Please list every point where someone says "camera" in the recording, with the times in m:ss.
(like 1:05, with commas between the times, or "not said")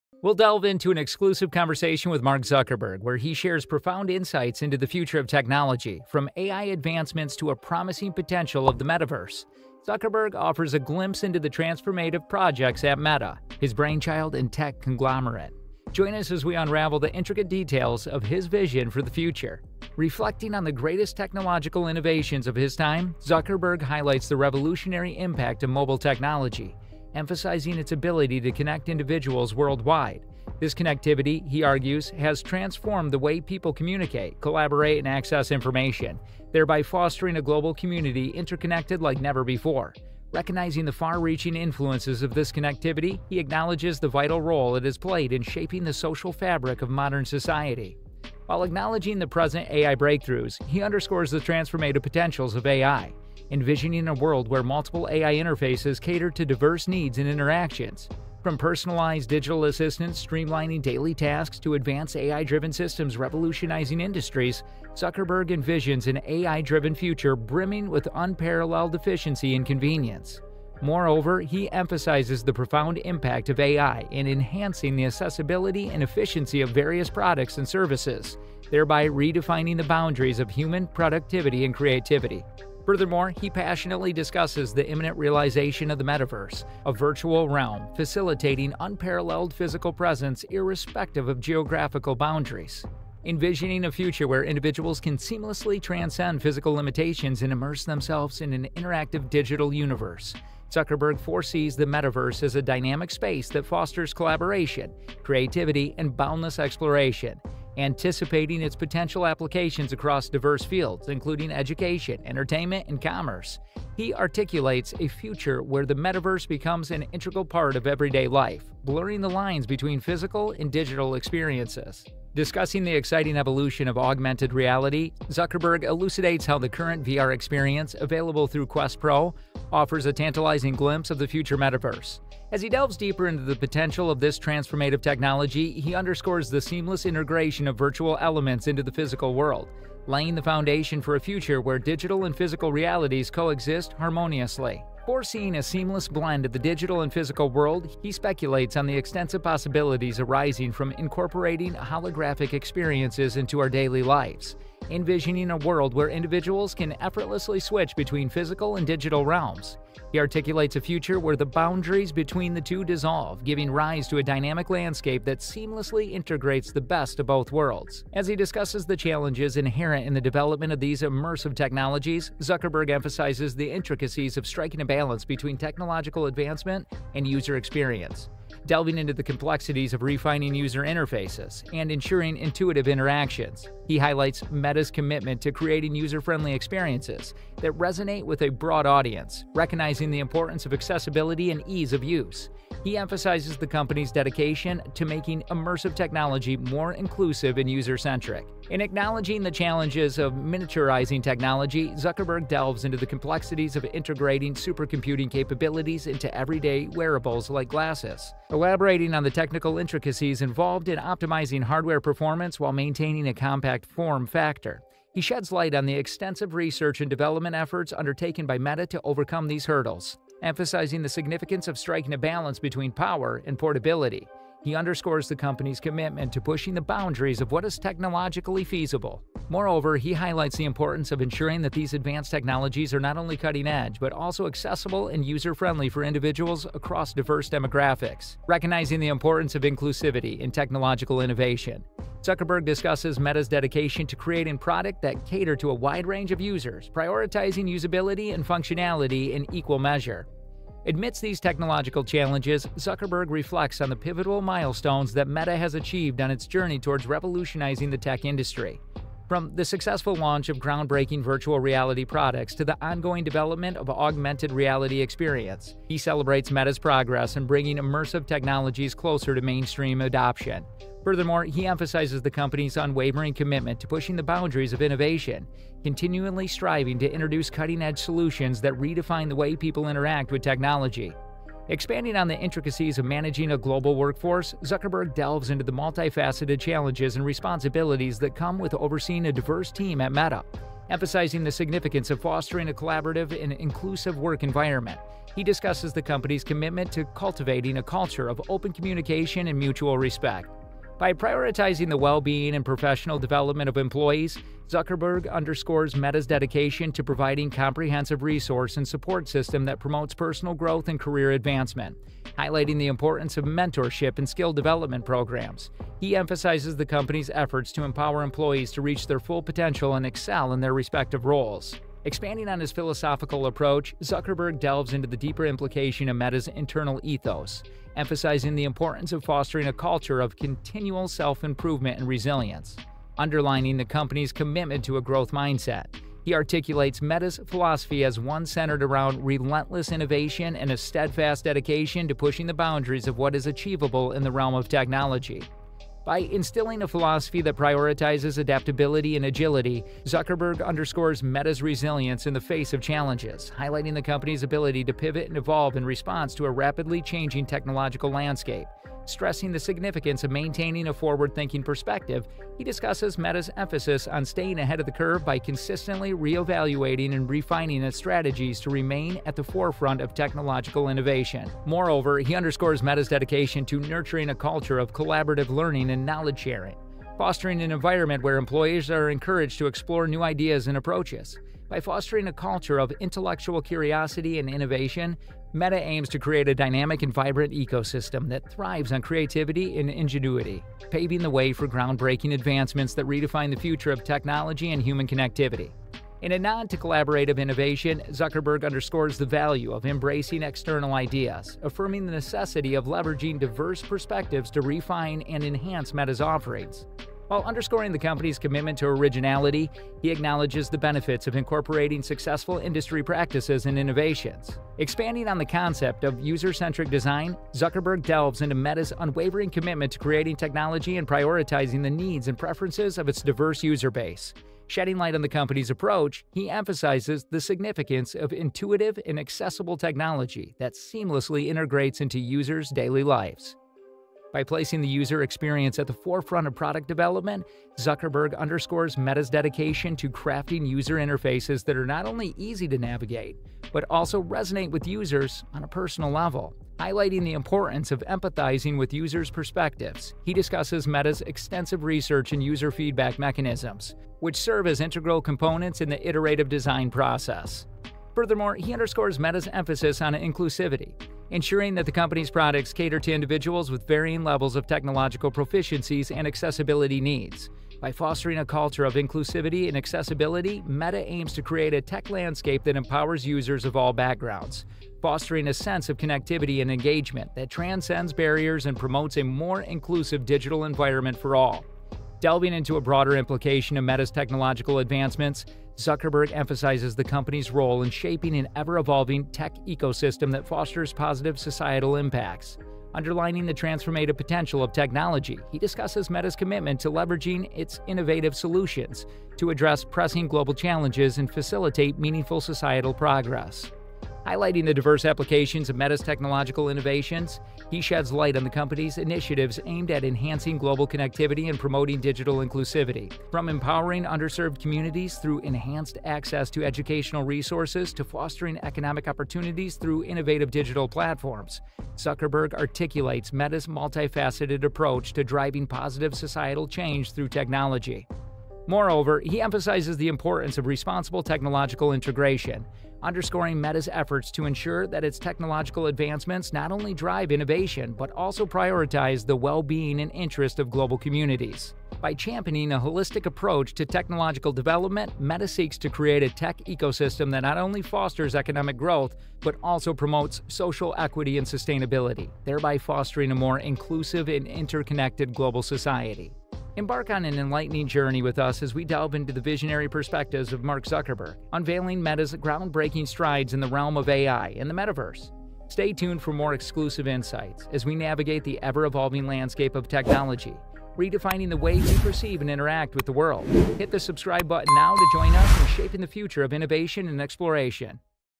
not said.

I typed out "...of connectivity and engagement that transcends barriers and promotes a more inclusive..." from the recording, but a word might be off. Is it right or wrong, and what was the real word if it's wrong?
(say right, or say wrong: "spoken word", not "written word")
right.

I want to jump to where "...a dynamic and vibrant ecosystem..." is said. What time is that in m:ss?
6:26.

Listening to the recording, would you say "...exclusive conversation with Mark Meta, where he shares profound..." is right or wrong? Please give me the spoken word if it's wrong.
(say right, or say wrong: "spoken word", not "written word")
wrong: "Zuckerberg", not "Meta".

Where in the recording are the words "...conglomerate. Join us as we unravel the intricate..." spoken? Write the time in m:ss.
0:14.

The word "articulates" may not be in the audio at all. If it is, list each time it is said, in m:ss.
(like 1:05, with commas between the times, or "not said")
1:54, 2:40, 5:36, 8:42.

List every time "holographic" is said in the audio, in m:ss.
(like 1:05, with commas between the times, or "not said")
2:31.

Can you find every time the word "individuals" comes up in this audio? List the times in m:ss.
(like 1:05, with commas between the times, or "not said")
0:28, 1:34, 2:36, 3:56, 7:43.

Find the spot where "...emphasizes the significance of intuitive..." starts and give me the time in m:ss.
7:06.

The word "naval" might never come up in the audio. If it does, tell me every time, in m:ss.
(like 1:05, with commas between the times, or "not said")
not said.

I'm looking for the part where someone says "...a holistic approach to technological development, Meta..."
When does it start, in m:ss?
9:02.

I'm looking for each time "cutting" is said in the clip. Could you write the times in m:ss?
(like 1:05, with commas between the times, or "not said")
3:53, 4:37.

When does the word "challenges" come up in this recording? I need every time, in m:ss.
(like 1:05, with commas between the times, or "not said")
2:48, 3:19, 4:12, 4:46, 5:52, 8:20.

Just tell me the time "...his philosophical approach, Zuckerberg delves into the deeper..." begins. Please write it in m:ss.
5:22.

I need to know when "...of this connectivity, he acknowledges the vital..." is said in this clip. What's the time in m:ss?
0:42.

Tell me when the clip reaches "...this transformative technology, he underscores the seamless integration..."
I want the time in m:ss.
2:14.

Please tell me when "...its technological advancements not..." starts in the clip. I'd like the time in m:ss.
8:55.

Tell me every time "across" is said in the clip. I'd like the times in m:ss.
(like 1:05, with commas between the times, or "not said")
1:49, 3:56.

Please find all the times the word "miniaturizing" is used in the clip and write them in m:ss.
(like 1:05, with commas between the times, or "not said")
3:20.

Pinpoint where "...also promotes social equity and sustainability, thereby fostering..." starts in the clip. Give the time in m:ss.
9:09.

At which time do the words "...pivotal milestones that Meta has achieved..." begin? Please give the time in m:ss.
4:13.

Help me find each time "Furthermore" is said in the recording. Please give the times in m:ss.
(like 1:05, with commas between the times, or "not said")
1:22, 4:31, 7:38.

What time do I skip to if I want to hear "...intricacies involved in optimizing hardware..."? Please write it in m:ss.
3:29.